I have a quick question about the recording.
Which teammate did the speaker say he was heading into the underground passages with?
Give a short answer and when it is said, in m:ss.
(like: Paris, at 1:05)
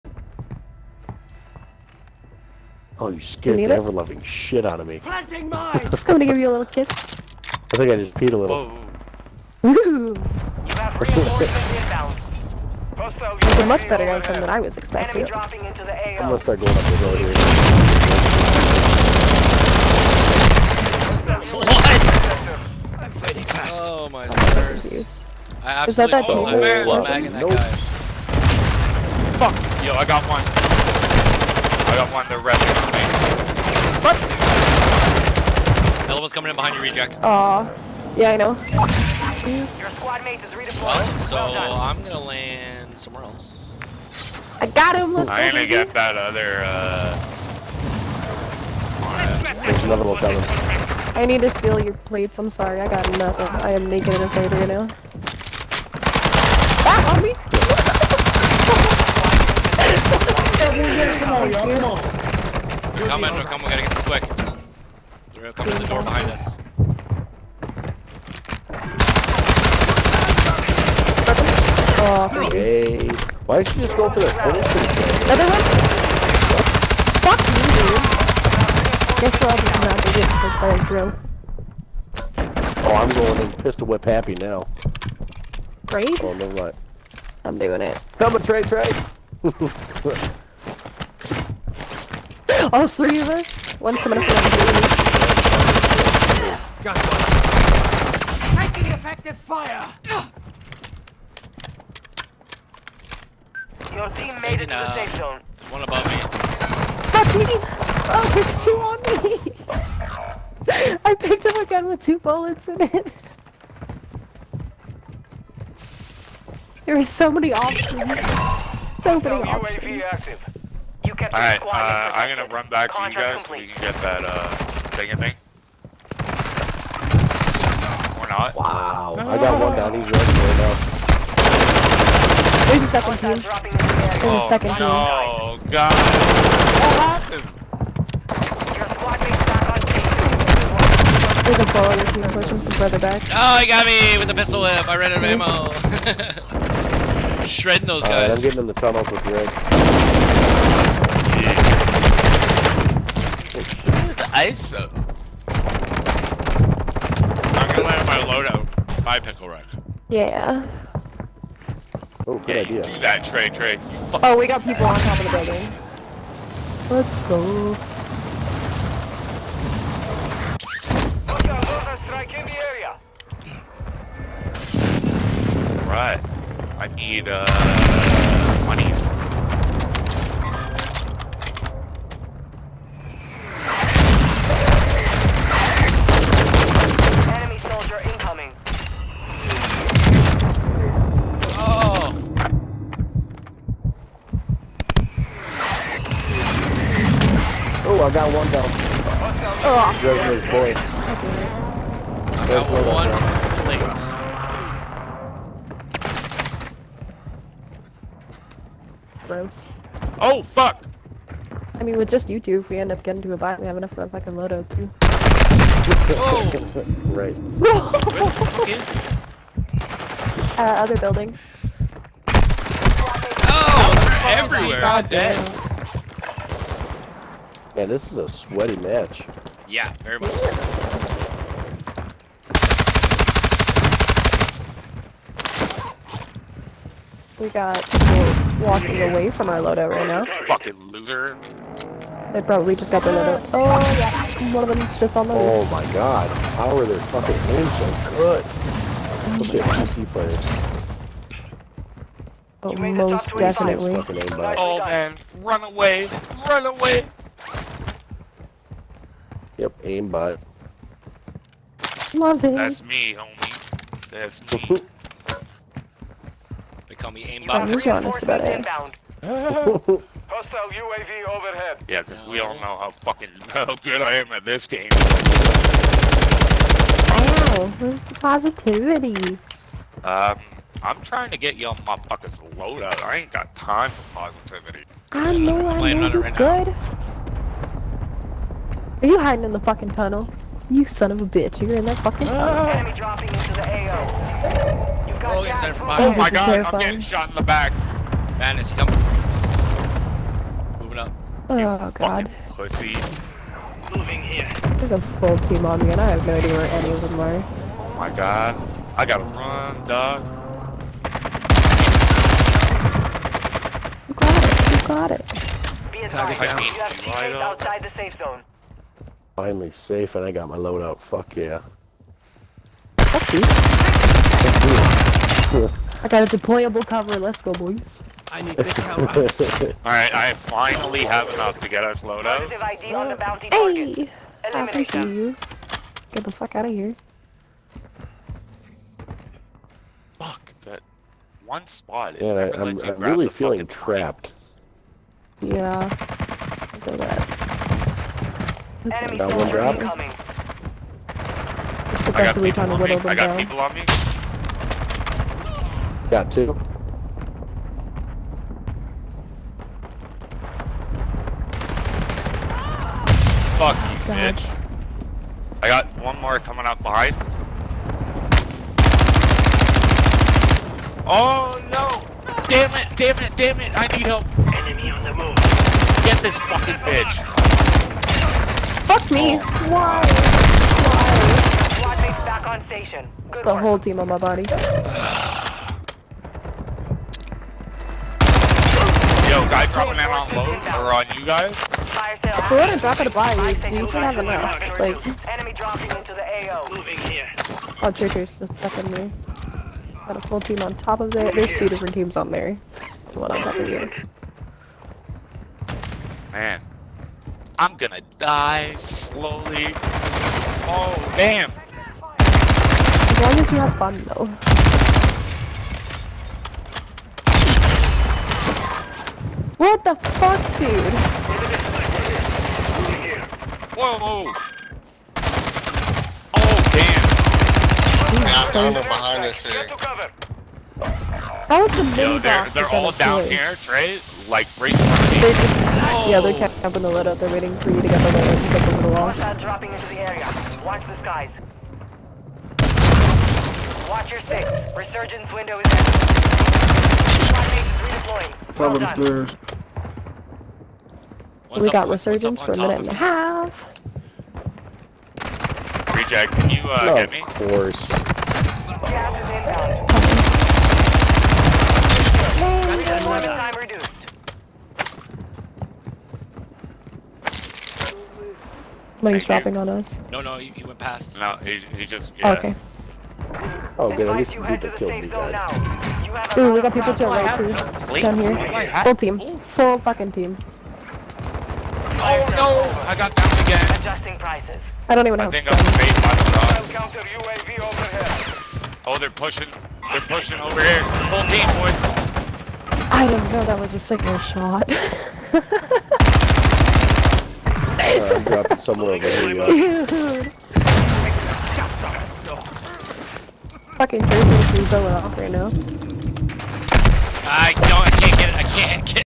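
Greg, at 2:29.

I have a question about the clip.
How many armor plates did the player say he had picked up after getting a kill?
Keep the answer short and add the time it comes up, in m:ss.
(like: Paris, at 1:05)
1, at 3:22.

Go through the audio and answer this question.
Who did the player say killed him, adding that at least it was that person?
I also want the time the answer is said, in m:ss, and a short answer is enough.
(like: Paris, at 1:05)
Vito, at 7:54.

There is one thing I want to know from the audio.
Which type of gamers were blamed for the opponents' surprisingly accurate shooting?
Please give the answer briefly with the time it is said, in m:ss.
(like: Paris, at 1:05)
PC players, at 4:09.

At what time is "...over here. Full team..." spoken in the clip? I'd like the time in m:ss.
8:10.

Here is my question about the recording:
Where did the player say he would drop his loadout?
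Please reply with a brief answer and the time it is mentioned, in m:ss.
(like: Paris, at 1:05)
by pickle rack, at 2:39.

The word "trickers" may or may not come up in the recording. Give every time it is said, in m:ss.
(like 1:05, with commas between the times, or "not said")
6:37.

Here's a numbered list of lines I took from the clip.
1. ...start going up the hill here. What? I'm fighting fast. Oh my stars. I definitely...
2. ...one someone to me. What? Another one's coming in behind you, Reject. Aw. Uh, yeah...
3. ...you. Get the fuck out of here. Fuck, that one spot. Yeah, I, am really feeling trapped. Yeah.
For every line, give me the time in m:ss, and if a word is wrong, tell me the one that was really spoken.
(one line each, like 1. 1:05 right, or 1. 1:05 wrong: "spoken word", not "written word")
1. 0:16 wrong: "absolutely", not "definitely"
2. 0:30 right
3. 5:35 right.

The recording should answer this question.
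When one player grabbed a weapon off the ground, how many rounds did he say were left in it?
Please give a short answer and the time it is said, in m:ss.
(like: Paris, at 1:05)
2, at 1:52.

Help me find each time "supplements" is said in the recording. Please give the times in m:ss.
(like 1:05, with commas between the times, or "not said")
not said.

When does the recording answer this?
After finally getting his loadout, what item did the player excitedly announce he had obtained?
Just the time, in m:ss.
5:26.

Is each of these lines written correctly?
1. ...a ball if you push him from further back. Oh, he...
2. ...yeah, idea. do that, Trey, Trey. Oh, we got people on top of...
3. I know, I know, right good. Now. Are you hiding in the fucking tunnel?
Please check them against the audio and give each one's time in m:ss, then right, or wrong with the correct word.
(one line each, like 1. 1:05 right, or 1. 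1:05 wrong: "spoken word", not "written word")
1. 2:18 right
2. 2:42 right
3. 4:45 right.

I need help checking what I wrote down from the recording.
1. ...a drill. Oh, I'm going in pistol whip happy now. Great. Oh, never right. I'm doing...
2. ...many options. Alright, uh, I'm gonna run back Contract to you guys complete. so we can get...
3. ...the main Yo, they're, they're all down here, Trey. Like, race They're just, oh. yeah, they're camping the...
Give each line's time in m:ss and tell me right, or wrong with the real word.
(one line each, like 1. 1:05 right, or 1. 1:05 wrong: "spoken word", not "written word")
1. 1:20 right
2. 1:59 right
3. 7:11 right.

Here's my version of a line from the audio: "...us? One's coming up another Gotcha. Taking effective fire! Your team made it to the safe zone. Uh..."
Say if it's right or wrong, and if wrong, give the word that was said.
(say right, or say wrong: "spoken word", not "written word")
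right.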